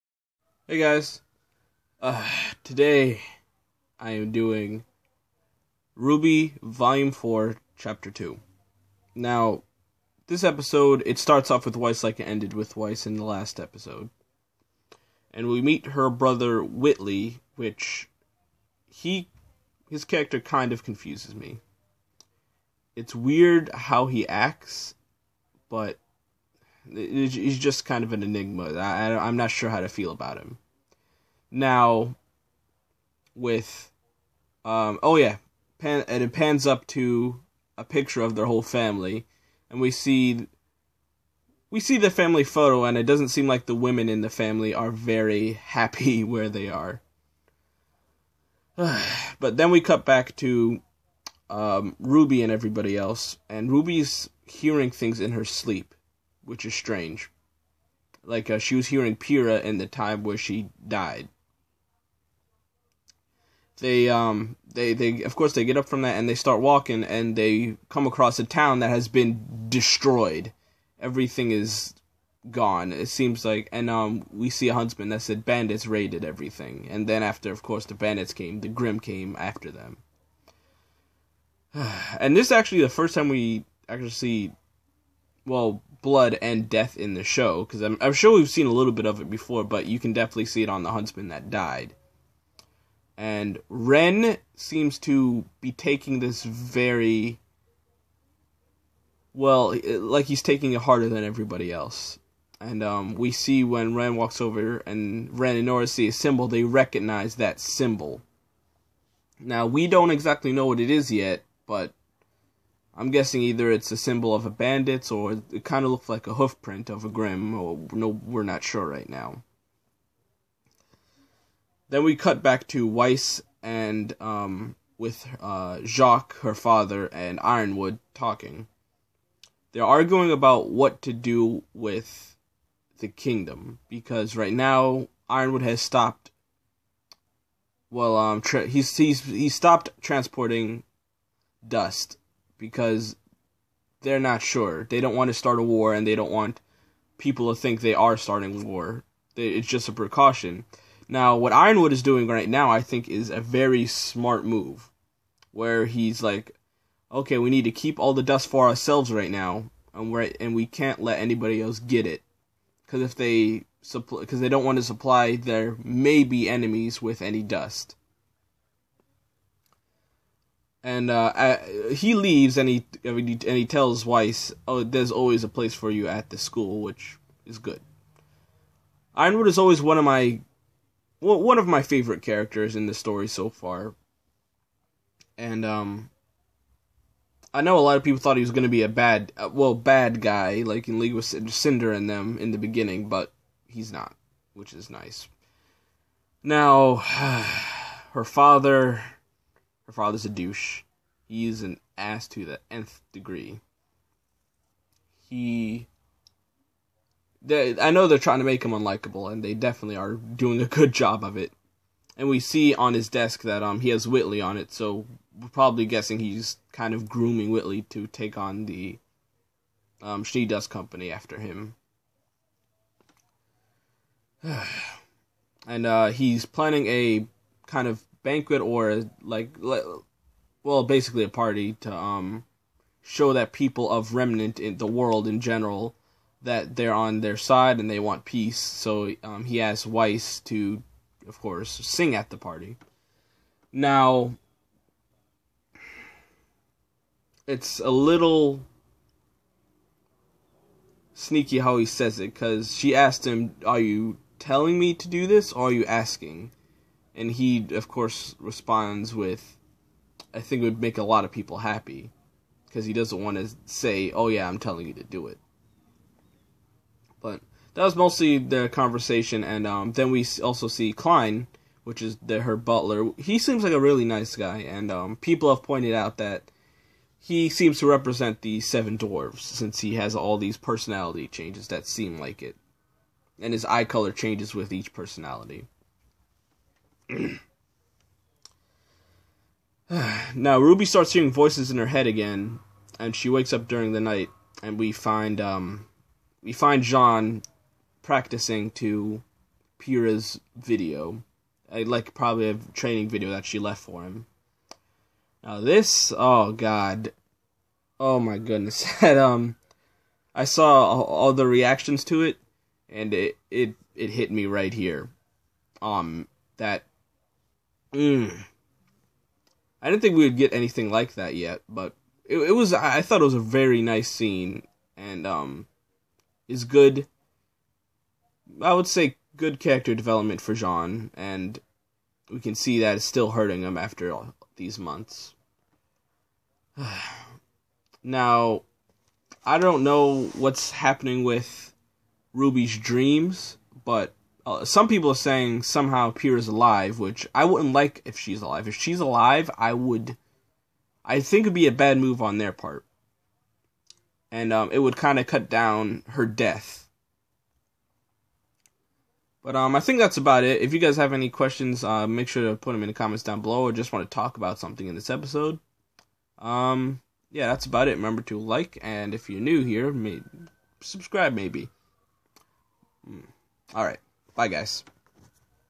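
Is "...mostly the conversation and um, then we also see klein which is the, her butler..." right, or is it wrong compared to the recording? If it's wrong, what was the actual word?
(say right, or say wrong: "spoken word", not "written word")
right.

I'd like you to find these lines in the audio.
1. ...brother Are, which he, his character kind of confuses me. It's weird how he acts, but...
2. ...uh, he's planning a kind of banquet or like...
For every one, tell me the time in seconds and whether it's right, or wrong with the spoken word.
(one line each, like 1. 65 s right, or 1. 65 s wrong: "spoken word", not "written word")
1. 16 s wrong: "Whitley", not "Are"
2. 225 s right.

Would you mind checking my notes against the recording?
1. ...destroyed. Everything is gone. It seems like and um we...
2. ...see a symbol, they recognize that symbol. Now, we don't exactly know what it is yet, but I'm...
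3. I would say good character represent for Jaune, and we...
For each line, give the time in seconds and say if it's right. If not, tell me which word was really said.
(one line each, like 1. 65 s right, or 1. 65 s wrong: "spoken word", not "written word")
1. 69 s right
2. 105 s right
3. 328 s wrong: "development", not "represent".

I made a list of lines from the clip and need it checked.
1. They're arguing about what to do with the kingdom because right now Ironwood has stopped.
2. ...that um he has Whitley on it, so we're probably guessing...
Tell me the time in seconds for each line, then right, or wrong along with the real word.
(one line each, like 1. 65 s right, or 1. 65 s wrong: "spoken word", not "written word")
1. 129 s right
2. 213 s right.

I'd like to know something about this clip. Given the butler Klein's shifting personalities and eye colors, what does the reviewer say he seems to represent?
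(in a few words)
The seven dwarves.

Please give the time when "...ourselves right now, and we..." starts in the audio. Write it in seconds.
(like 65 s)
158 s.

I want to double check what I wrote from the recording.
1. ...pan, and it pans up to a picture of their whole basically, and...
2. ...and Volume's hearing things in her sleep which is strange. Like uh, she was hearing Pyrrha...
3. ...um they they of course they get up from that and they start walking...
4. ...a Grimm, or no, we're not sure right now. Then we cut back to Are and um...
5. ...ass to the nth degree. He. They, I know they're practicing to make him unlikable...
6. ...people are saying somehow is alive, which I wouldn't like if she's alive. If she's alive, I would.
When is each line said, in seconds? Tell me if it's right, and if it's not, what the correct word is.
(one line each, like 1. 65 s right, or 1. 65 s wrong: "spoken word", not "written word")
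1. 35 s wrong: "family", not "basically"
2. 53 s wrong: "Ruby", not "Volume"
3. 64 s right
4. 117 s wrong: "Weiss", not "Are"
5. 201 s wrong: "trying", not "practicing"
6. 344 s right.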